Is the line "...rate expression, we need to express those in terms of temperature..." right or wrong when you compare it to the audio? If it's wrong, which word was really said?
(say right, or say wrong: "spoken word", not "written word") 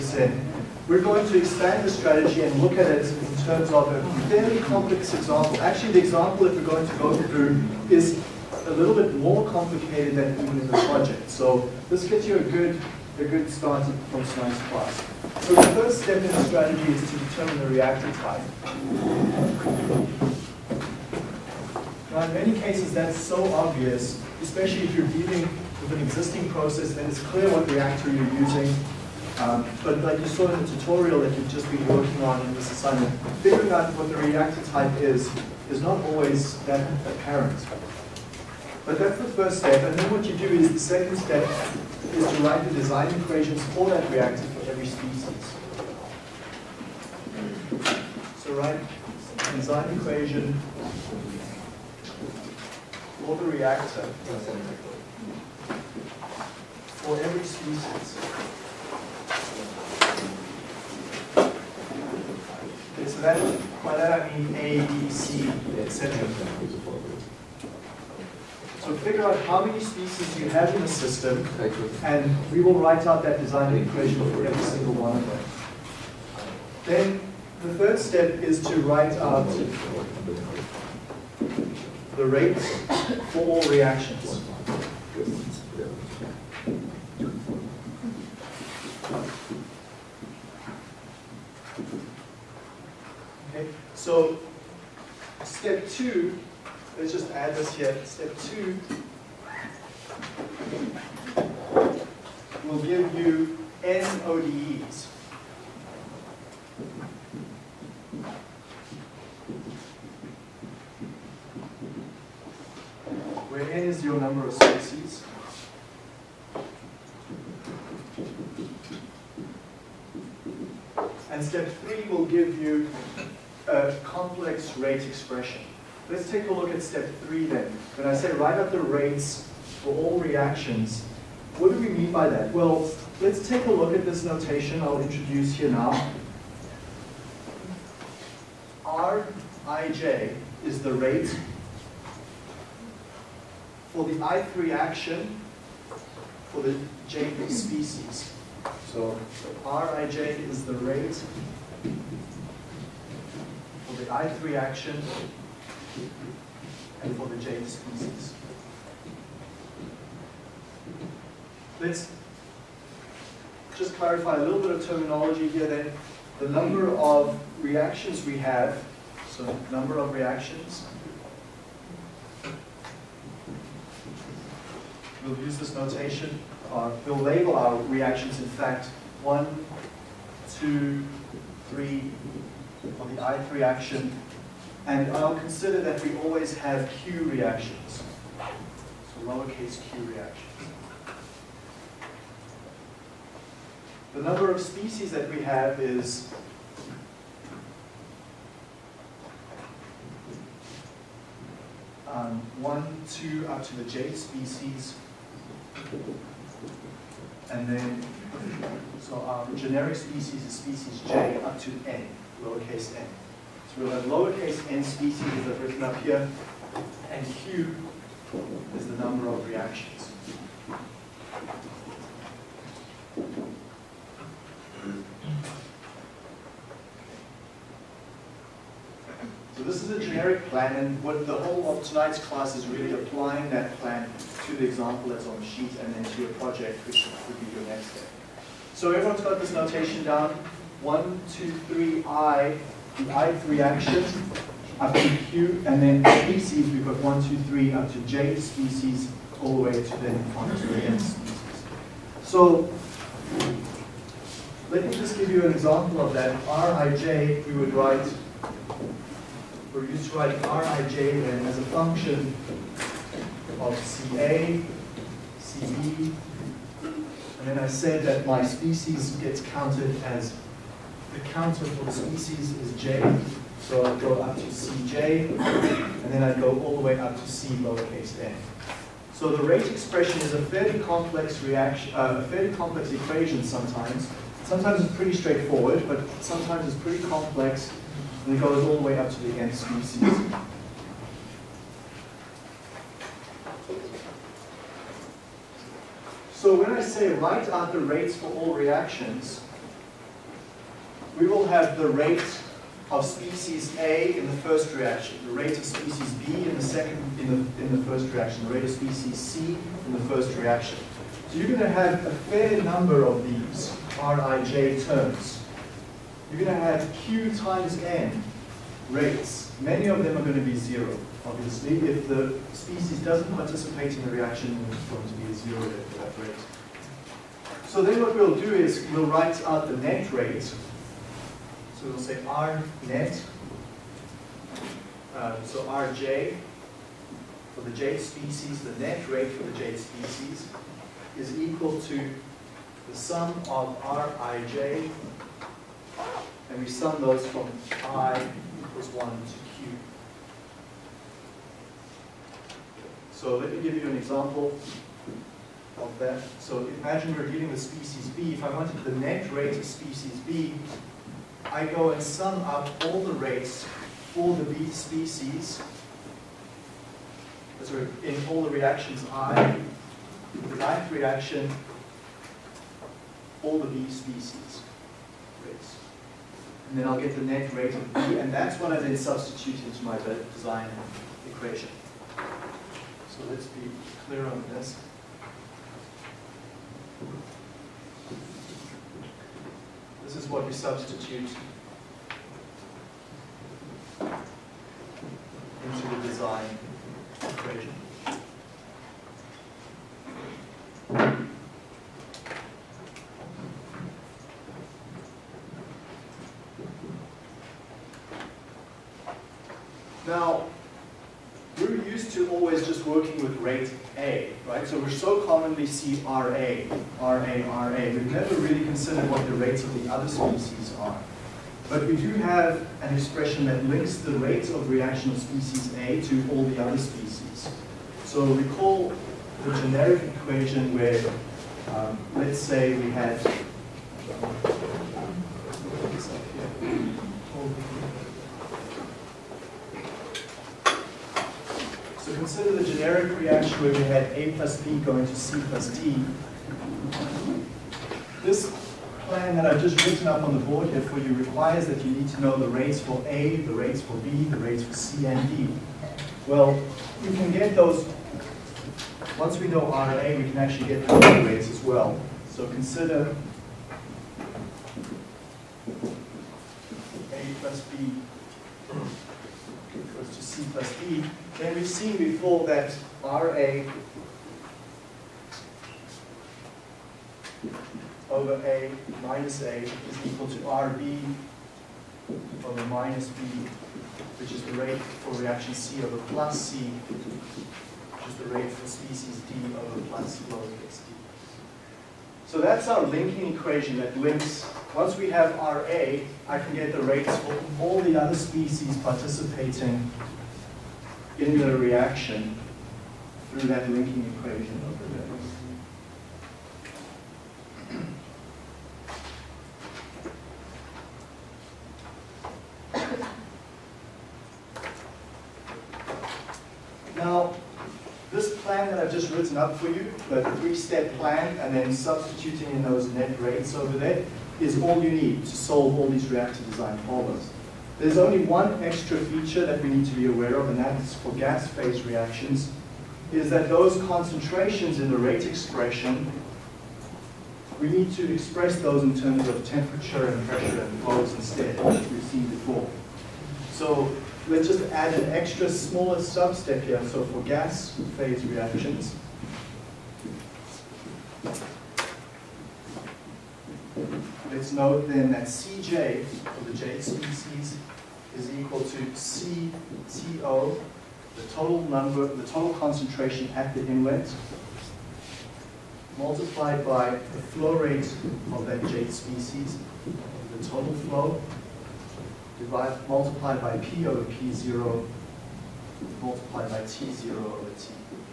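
right.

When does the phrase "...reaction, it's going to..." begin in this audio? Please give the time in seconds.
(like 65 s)
324 s.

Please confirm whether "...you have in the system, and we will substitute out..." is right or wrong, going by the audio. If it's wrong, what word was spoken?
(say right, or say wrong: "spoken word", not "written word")
wrong: "write", not "substitute".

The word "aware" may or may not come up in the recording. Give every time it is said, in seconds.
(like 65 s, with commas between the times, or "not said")
530 s.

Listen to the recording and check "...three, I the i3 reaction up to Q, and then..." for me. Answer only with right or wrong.
right.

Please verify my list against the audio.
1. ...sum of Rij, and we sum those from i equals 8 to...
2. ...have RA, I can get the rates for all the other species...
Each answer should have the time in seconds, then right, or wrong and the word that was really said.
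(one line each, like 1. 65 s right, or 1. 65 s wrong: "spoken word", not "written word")
1. 342 s wrong: "1", not "8"
2. 495 s right.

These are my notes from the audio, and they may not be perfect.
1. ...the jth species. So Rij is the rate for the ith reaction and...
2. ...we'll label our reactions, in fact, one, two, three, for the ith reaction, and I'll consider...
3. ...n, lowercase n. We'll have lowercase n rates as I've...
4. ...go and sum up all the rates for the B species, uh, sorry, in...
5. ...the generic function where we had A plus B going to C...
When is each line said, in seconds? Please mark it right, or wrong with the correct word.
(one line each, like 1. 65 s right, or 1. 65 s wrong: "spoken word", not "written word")
1. 146 s right
2. 177 s right
3. 211 s wrong: "species", not "rates"
4. 361 s right
5. 442 s wrong: "reaction", not "function".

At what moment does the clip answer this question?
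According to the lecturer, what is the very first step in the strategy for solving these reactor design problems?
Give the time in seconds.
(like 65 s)
17 s.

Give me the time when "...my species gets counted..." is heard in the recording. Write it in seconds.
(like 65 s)
268 s.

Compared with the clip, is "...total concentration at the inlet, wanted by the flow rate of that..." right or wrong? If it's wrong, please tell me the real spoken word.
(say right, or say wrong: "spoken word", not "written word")
wrong: "multiplied", not "wanted".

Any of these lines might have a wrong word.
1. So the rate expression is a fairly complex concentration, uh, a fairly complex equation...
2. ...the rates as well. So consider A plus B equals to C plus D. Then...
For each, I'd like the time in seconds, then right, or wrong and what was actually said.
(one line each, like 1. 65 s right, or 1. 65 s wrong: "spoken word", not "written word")
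1. 279 s wrong: "reaction", not "concentration"
2. 460 s right.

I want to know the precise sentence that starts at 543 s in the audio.
So let's just add an extra smaller substep here.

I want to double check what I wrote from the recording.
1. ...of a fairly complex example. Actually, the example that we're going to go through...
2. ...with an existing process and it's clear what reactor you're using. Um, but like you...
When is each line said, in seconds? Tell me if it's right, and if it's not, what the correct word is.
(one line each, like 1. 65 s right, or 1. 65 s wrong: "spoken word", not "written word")
1. 3 s right
2. 25 s right.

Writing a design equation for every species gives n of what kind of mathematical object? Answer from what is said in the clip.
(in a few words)
ODEs.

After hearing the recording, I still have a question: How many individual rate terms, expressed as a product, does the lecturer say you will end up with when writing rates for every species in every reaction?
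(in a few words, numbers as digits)
Q times N.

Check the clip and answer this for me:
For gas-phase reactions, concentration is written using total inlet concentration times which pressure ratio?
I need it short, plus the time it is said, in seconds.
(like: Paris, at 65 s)
P over P0, at 573 s.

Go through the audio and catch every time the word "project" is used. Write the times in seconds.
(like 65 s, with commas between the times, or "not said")
10 s, 236 s.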